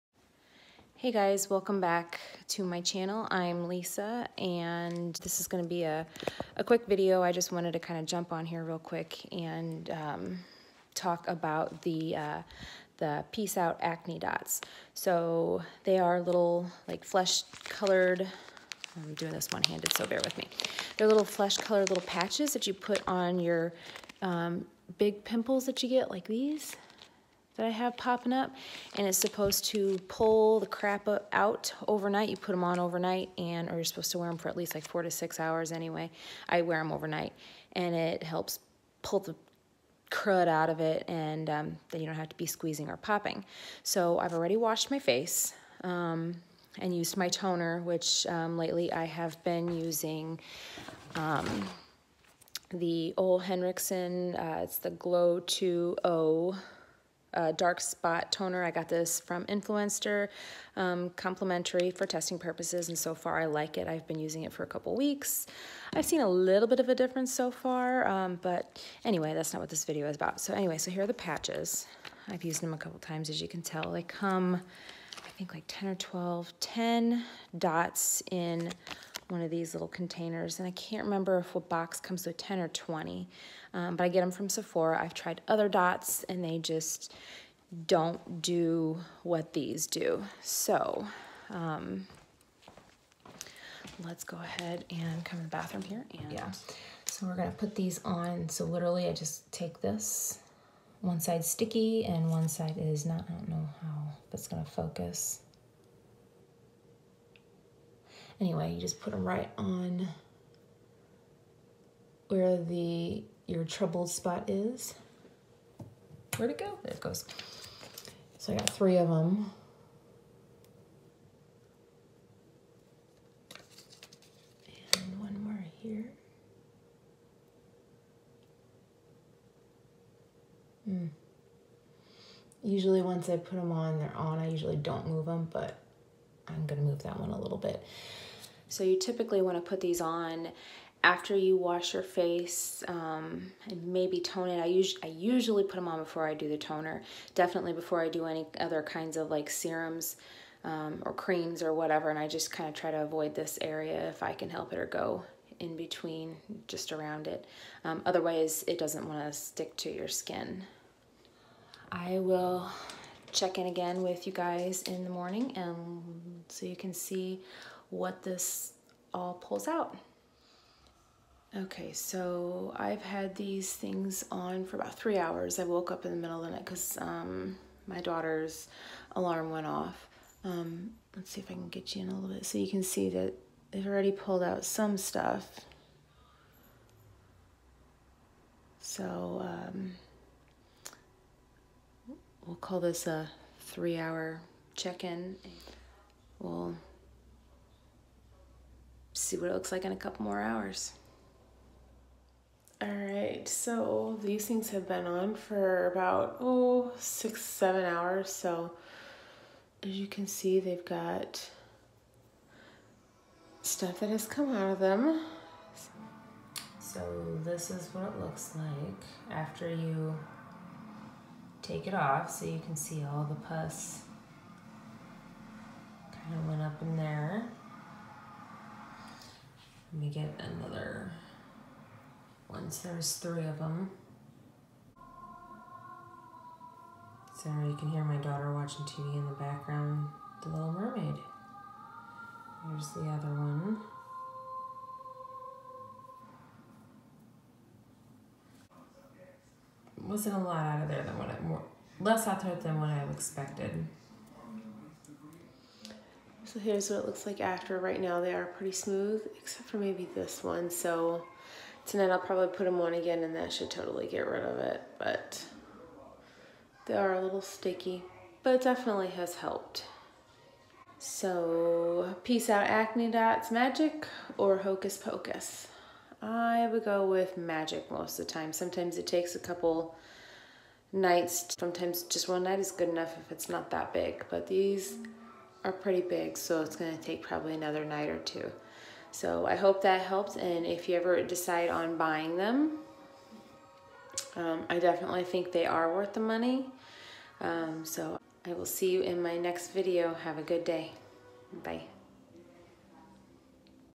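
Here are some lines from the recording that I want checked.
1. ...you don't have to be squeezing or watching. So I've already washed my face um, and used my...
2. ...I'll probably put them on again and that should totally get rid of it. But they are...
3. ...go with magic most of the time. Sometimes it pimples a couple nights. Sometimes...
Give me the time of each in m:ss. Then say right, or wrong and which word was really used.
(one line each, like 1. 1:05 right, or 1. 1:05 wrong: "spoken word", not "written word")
1. 0:42 wrong: "popping", not "watching"
2. 4:22 right
3. 4:36 wrong: "takes", not "pimples".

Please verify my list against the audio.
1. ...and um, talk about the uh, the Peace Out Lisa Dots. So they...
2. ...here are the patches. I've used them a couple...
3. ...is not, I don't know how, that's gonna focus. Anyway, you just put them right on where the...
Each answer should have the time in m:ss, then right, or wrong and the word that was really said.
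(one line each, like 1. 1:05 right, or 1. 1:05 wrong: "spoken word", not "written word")
1. 0:09 wrong: "Acne", not "Lisa"
2. 1:10 right
3. 1:42 right.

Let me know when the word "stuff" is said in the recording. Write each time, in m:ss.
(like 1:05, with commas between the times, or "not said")
3:04, 3:33.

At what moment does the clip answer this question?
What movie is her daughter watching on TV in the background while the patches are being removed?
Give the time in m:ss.
4:00.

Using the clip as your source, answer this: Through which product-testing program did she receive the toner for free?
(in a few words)
Influenster.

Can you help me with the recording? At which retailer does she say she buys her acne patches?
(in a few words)
Sephora.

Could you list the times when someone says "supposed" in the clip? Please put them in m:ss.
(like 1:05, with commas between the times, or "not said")
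0:29, 0:33.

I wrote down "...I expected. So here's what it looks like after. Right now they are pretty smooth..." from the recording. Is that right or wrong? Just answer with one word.
right.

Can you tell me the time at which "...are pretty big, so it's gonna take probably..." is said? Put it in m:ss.
4:45.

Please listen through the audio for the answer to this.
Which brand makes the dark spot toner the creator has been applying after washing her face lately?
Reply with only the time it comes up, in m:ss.
0:53.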